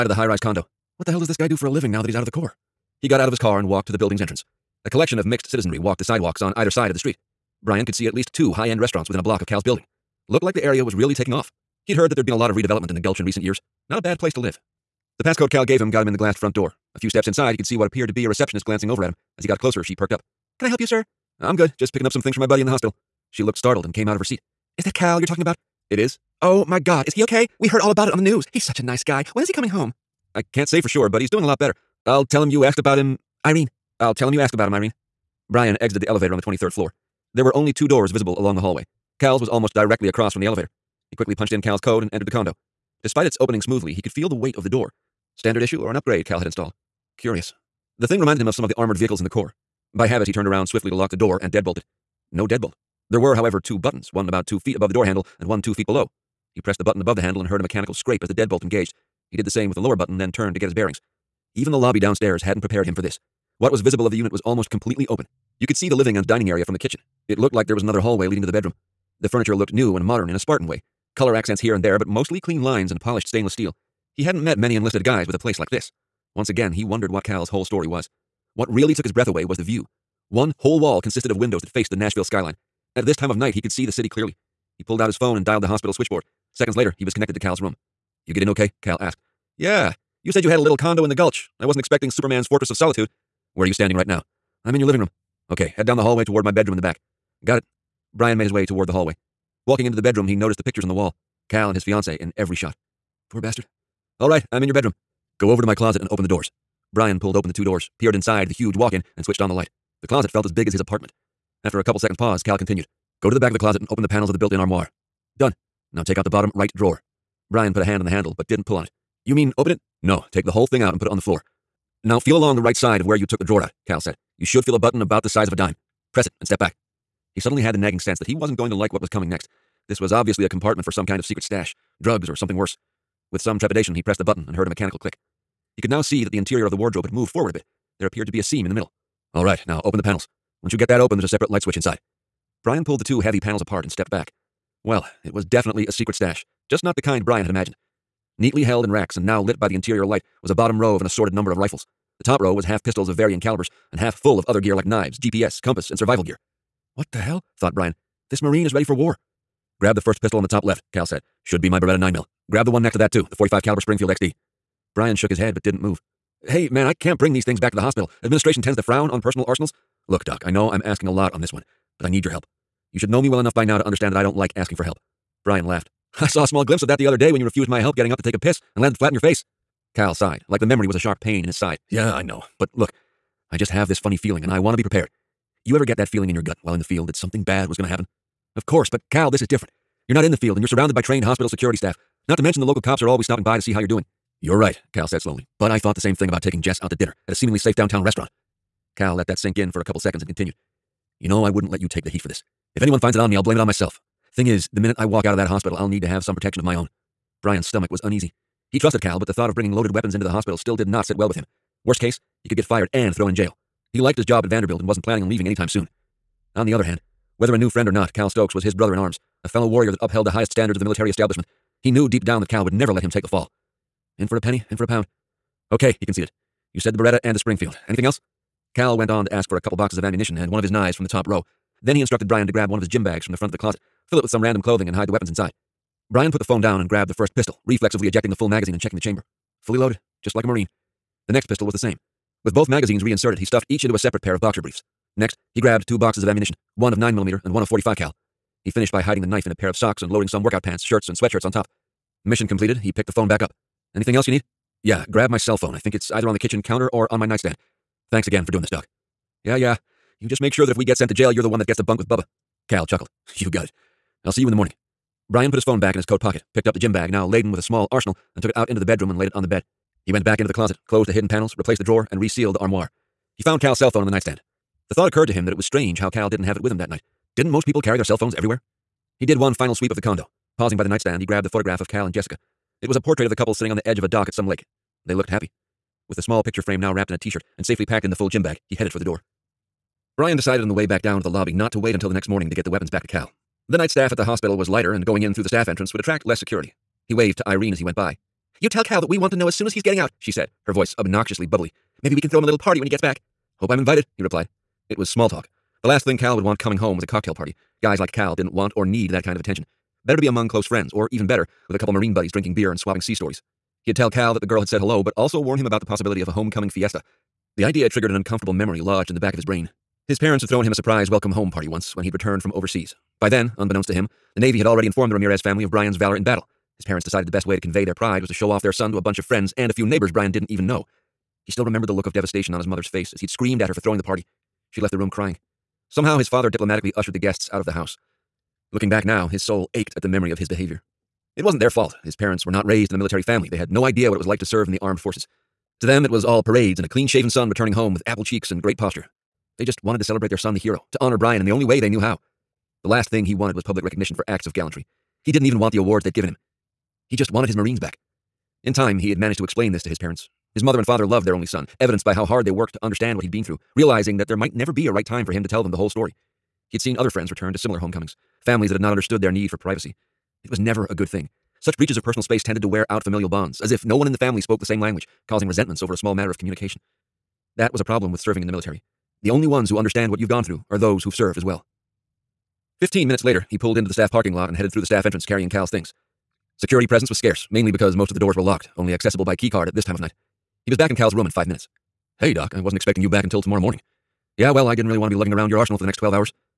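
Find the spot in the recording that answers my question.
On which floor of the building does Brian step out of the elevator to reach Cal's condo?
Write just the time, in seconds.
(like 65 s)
36 s.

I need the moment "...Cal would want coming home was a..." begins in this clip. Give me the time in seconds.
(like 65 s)
306 s.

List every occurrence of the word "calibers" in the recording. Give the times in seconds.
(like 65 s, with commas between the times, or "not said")
153 s, 163 s.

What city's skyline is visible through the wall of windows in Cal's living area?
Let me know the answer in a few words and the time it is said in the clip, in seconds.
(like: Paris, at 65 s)
Nashville, at 81 s.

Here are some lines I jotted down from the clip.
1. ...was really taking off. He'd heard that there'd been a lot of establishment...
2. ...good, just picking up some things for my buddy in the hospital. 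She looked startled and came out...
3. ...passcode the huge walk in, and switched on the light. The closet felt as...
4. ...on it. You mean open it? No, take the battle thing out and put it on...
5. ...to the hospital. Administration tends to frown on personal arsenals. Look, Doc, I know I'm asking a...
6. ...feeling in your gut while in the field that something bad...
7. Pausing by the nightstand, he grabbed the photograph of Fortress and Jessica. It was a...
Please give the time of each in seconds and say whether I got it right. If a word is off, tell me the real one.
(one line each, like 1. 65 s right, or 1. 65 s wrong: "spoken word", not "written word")
1. 10 s wrong: "redevelopment", not "establishment"
2. 21 s right
3. 108 s wrong: "inside", not "passcode"
4. 118 s wrong: "whole", not "battle"
5. 167 s right
6. 186 s right
7. 280 s wrong: "Cal", not "Fortress".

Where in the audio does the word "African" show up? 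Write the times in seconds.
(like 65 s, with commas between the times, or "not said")
not said.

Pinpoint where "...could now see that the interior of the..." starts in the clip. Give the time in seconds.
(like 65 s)
135 s.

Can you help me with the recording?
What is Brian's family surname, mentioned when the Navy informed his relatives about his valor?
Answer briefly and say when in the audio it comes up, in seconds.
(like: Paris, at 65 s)
Ramirez, at 325 s.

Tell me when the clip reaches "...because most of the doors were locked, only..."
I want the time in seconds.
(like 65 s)
387 s.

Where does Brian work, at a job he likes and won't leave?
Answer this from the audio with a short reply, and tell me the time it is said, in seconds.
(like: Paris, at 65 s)
Vanderbilt, at 214 s.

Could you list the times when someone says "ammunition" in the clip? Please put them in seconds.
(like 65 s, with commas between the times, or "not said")
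230 s, 246 s.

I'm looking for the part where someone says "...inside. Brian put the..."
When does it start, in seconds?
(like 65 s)
235 s.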